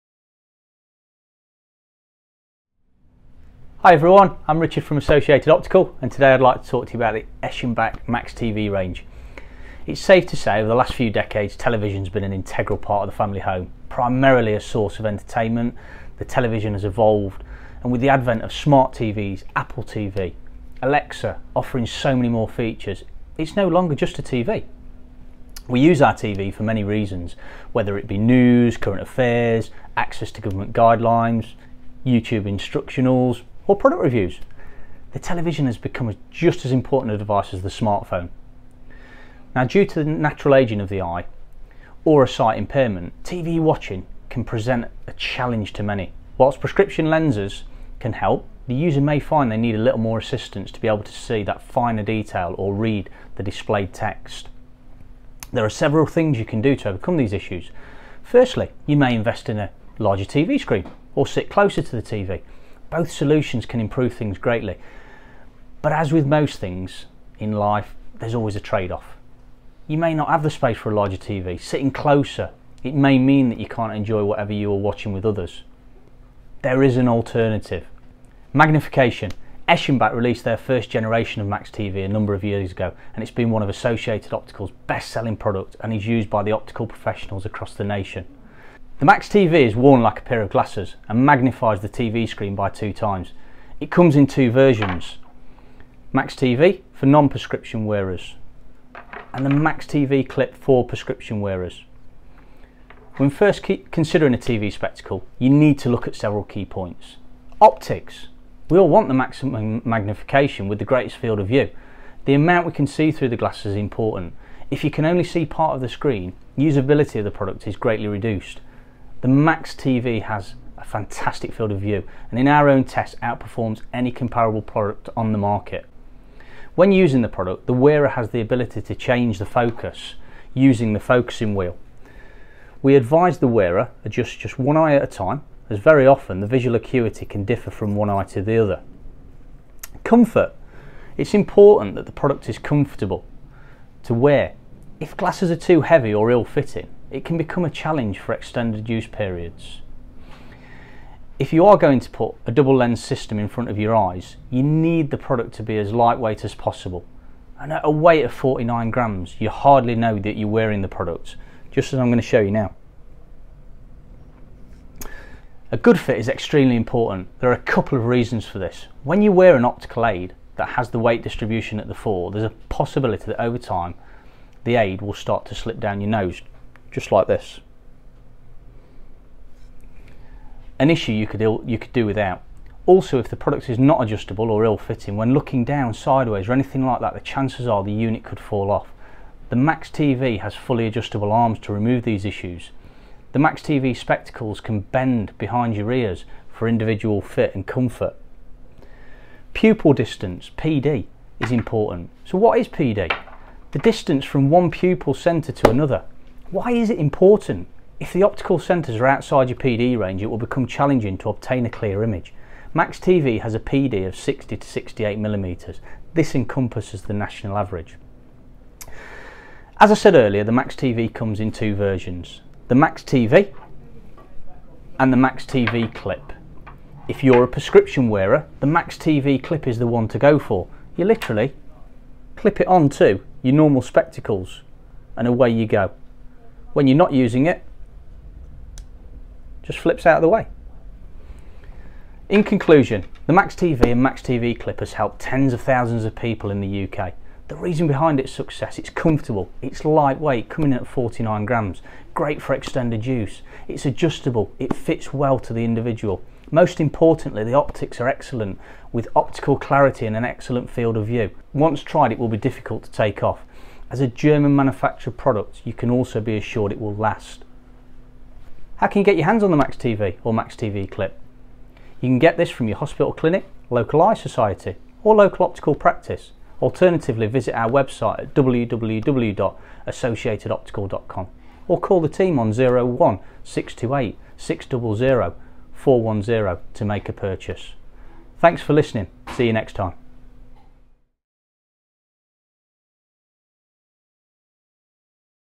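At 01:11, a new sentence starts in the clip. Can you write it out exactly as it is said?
Sitting closer, it may mean that you can't enjoy whatever you are watching with others.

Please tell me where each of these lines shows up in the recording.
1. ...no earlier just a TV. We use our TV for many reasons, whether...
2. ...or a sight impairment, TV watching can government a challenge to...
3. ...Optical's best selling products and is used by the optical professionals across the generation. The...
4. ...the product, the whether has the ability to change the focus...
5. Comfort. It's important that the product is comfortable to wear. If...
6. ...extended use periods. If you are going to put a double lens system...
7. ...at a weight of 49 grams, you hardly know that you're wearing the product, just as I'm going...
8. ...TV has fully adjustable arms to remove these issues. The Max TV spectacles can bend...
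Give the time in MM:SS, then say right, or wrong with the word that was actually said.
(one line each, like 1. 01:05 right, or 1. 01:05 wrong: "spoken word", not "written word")
1. 00:23 wrong: "longer", not "earlier"
2. 00:42 wrong: "present", not "government"
3. 01:24 wrong: "nation", not "generation"
4. 02:07 wrong: "wearer", not "whether"
5. 02:20 right
6. 02:28 right
7. 02:37 right
8. 03:09 right.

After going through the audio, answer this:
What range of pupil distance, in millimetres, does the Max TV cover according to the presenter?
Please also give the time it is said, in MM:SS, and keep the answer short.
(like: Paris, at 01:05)
60 to 68 millimetres, at 03:34.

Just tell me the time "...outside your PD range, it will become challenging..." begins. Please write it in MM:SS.
03:29.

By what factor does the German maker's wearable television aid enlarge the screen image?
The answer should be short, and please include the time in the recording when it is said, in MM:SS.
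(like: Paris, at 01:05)
2 times, at 01:32.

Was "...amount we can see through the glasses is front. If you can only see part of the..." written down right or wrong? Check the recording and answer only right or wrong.
wrong.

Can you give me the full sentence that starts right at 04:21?
Once tried, it will be difficult to take off.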